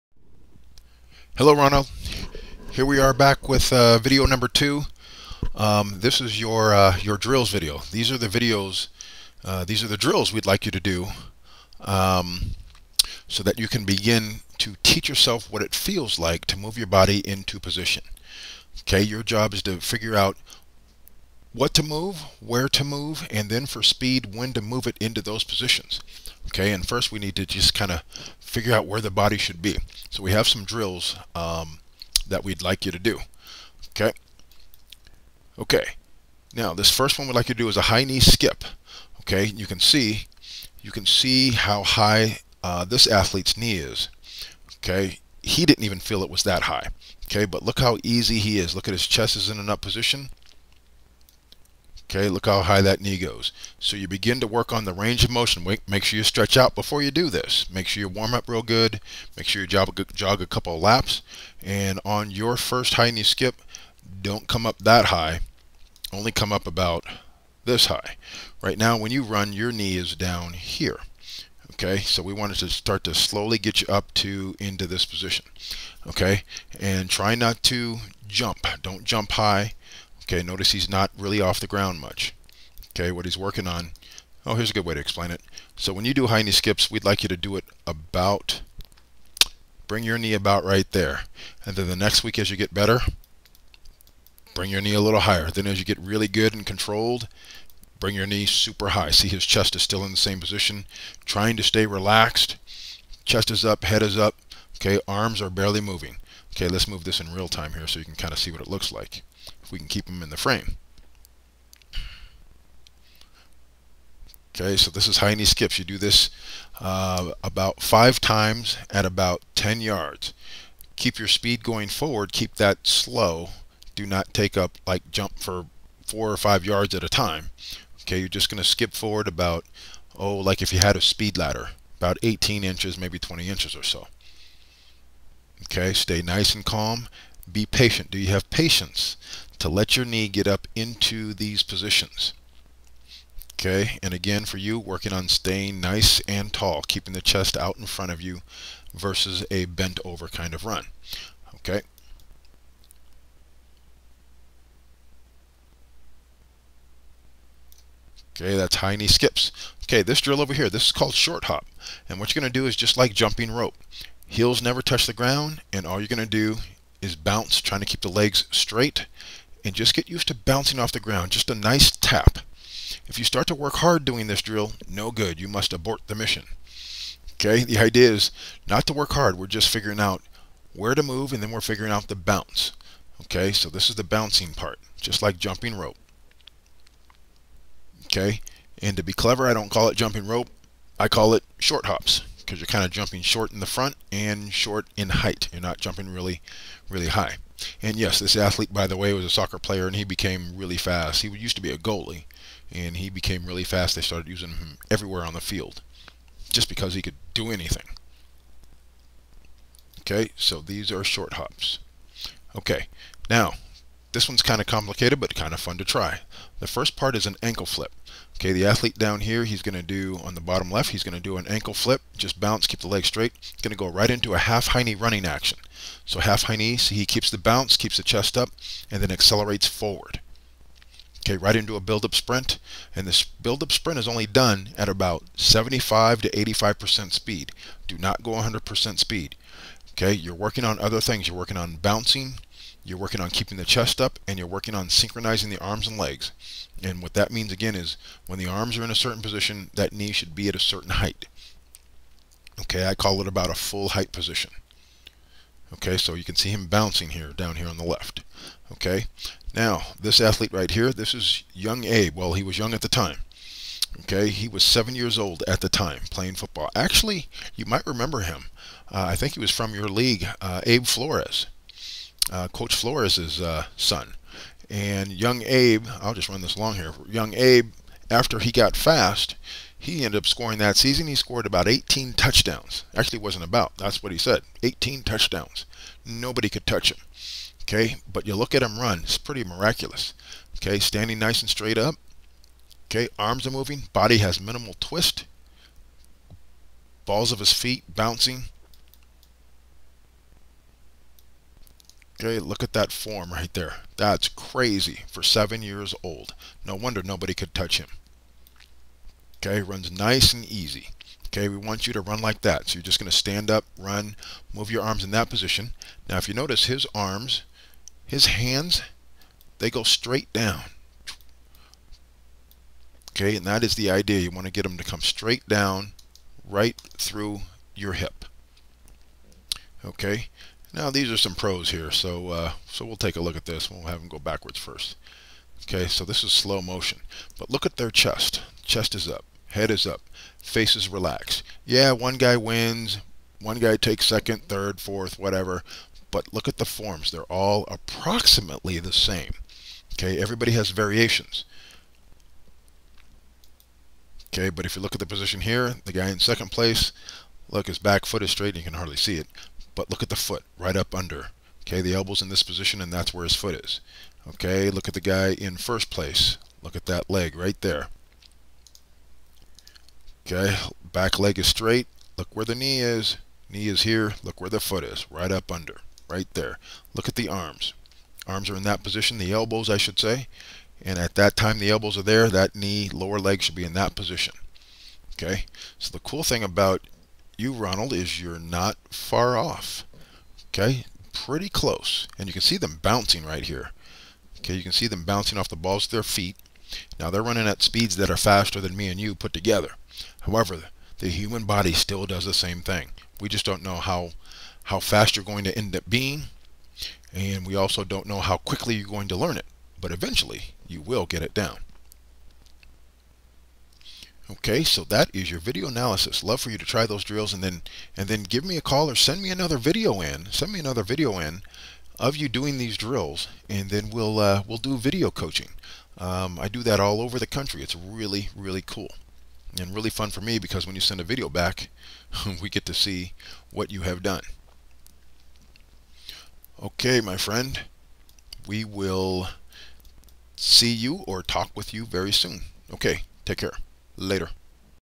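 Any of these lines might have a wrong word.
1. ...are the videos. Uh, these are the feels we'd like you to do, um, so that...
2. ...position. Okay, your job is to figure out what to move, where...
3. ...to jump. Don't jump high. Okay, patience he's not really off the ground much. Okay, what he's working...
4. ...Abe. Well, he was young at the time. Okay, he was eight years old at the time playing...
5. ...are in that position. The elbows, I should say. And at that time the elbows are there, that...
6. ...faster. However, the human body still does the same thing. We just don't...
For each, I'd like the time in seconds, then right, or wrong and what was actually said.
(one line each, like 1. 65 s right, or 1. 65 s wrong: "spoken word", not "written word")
1. 8 s wrong: "drills", not "feels"
2. 17 s right
3. 77 s wrong: "notice", not "patience"
4. 261 s wrong: "seven", not "eight"
5. 378 s right
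6. 399 s wrong: "together", not "faster".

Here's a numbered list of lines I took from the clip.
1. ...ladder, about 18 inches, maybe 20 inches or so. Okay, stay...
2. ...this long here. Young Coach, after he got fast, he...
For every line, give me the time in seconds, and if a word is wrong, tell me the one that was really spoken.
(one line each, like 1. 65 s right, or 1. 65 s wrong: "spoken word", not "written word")
1. 131 s right
2. 276 s wrong: "Abe", not "Coach".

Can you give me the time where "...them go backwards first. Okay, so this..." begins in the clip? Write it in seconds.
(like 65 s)
333 s.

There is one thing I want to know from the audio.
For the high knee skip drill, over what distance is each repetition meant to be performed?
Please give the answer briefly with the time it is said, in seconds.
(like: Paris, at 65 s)
10 yards, at 119 s.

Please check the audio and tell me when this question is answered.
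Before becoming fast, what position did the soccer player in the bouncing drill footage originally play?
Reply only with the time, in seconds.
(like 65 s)
201 s.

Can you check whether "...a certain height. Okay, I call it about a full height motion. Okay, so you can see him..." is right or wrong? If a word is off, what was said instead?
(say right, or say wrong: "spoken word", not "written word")
wrong: "position", not "motion".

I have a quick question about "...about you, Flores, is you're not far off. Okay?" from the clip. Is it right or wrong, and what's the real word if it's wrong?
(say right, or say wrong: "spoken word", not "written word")
wrong: "Ronald", not "Flores".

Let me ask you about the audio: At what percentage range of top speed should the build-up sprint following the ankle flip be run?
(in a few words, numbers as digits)
75 to 85%.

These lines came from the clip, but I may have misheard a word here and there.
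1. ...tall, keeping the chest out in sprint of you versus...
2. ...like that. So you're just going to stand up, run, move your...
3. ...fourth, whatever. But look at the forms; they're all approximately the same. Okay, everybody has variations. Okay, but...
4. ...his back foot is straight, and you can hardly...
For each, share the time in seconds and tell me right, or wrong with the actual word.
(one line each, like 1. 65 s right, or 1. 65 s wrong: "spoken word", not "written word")
1. 146 s wrong: "front", not "sprint"
2. 312 s right
3. 344 s right
4. 357 s right.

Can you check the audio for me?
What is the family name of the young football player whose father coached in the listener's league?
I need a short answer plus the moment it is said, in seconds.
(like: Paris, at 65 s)
Flores, at 270 s.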